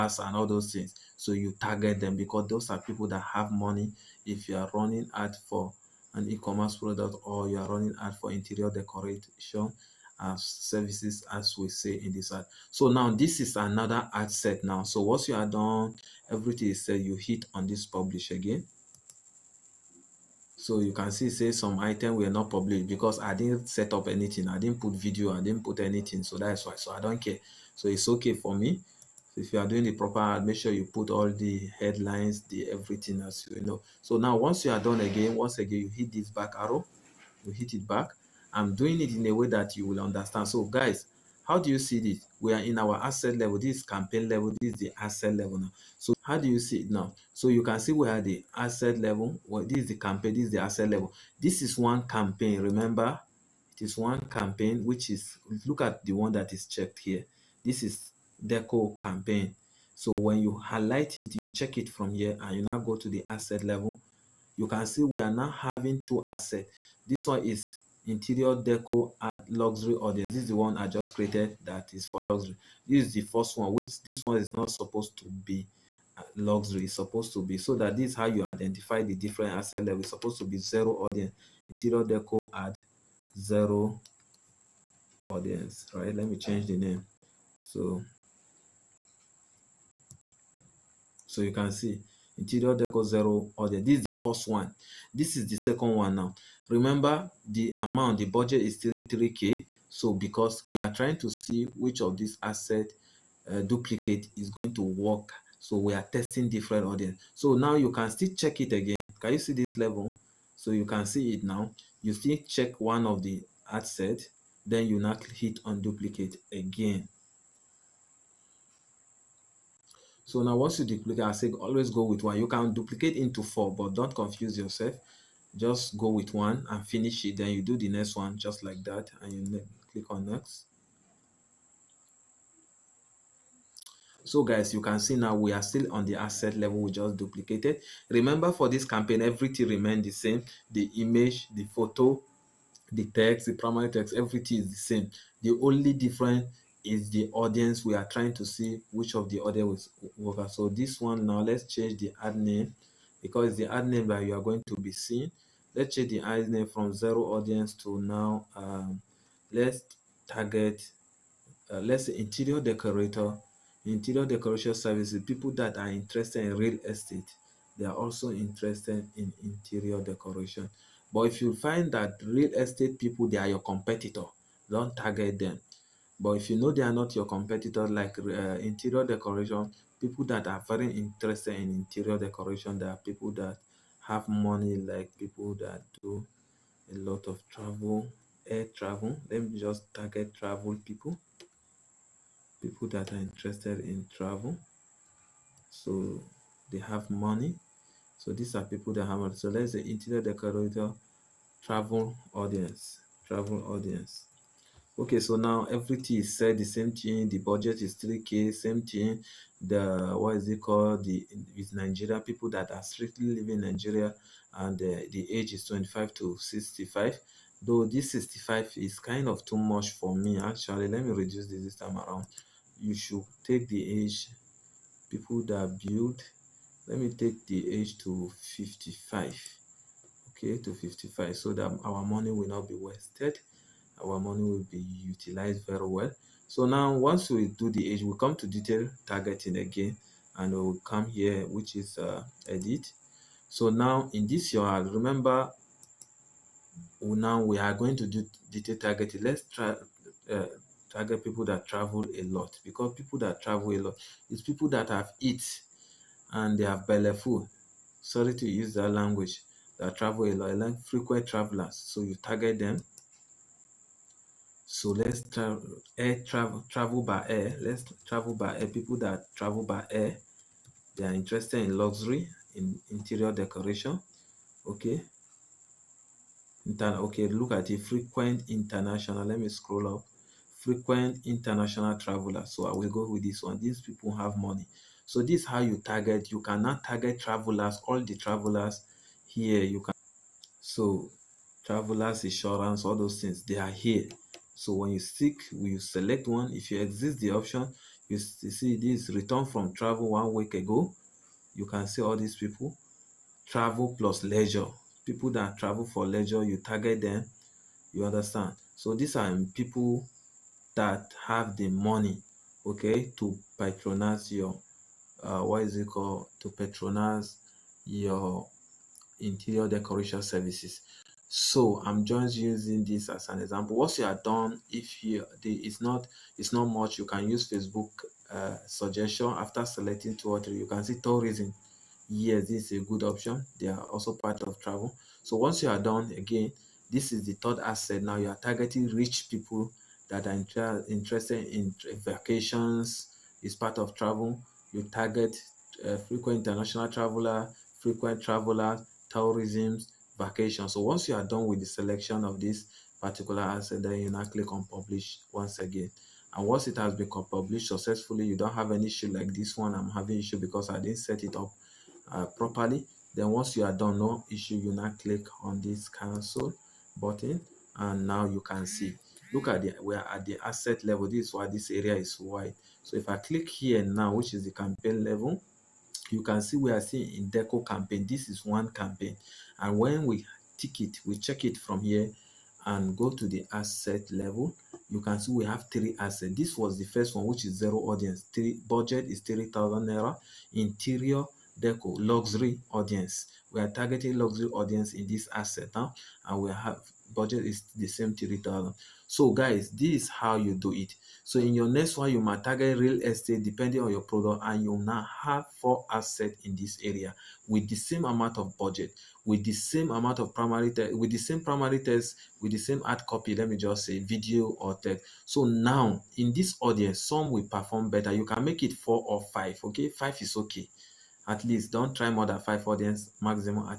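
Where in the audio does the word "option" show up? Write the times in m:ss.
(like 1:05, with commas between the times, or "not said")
4:57, 5:33.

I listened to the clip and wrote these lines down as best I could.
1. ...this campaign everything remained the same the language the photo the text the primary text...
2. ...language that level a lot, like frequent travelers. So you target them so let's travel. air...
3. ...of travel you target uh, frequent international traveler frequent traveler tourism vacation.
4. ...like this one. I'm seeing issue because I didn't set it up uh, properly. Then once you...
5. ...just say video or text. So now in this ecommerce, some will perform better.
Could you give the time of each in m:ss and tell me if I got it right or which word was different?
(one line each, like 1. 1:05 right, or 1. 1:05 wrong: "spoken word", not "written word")
1. 2:18 wrong: "image", not "language"
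2. 4:18 wrong: "travel", not "level"
3. 5:43 right
4. 5:59 wrong: "having", not "seeing"
5. 6:53 wrong: "audience", not "ecommerce".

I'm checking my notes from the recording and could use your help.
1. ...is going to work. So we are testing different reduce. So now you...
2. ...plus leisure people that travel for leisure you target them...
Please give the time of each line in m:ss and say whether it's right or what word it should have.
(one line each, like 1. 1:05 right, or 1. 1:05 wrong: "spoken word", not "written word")
1. 1:44 wrong: "audience", not "reduce"
2. 5:03 right.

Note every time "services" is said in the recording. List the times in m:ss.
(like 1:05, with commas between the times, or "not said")
0:10, 2:44, 5:20.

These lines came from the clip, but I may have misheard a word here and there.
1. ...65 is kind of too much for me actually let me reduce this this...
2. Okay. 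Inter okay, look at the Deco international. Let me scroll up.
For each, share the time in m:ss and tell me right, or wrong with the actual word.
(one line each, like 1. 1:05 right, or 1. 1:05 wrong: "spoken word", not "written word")
1. 3:38 right
2. 4:34 wrong: "Frequent", not "Deco".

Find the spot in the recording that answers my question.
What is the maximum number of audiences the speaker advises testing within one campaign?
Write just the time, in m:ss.
7:02.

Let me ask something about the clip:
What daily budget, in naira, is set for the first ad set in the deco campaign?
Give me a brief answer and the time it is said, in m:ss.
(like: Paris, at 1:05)
3000 naira, at 6:29.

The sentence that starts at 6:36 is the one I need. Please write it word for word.
and we have budget is the same 3000 So guys, this is how you do it.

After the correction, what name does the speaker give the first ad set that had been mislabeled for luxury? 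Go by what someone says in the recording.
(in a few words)
Interior deco zero audience.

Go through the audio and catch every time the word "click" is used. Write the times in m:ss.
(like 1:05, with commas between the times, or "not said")
2:09, 5:54, 6:05, 6:13.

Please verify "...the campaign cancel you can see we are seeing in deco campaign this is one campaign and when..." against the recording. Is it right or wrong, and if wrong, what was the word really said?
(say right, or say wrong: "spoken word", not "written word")
wrong: "level", not "cancel".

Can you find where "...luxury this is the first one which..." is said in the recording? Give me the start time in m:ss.
1:12.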